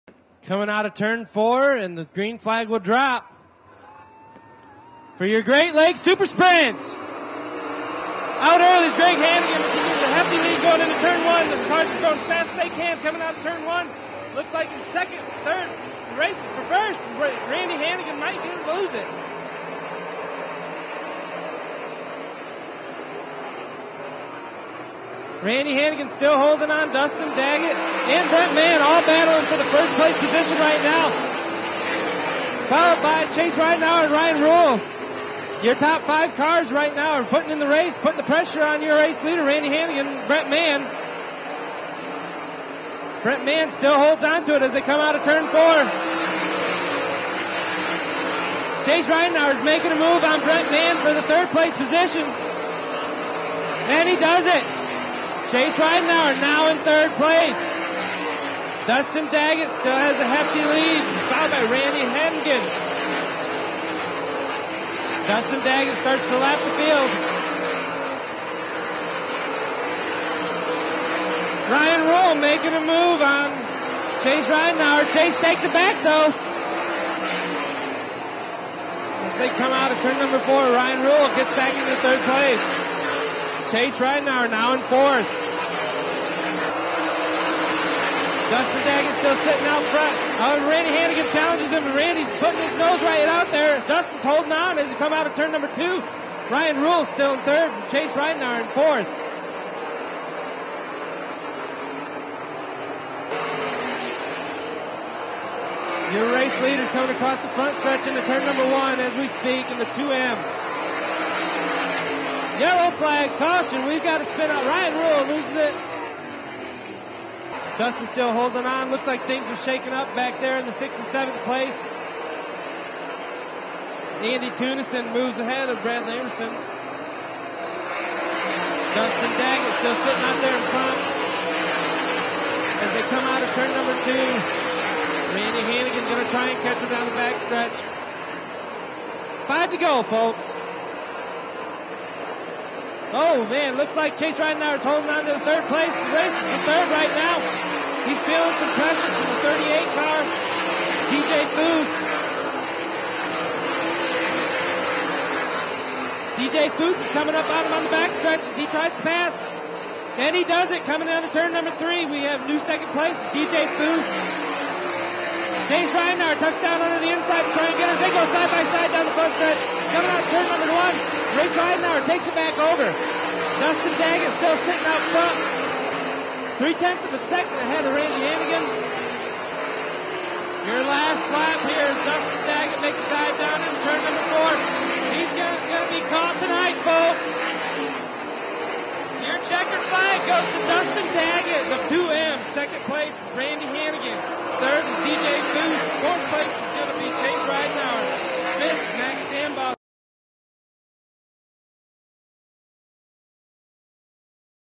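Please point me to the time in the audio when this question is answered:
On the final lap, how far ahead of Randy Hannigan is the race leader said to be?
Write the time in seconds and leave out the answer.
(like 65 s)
176 s.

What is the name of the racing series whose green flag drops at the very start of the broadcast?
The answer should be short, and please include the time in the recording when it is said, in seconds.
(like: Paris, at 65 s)
Great Lakes Super Sprints, at 5 s.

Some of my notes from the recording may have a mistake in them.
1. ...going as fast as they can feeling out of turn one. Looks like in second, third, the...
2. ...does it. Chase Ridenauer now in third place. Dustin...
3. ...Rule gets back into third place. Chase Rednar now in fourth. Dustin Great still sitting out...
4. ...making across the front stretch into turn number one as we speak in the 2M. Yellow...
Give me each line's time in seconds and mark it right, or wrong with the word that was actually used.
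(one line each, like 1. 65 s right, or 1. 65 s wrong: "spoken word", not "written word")
1. 12 s wrong: "coming", not "feeling"
2. 54 s right
3. 81 s wrong: "Daggett", not "Great"
4. 106 s wrong: "coming", not "making".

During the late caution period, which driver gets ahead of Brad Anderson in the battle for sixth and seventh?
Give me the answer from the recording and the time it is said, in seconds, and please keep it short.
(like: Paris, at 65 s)
Andy Tunison, at 124 s.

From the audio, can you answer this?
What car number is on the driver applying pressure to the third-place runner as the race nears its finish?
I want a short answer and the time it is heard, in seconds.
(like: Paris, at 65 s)
38, at 149 s.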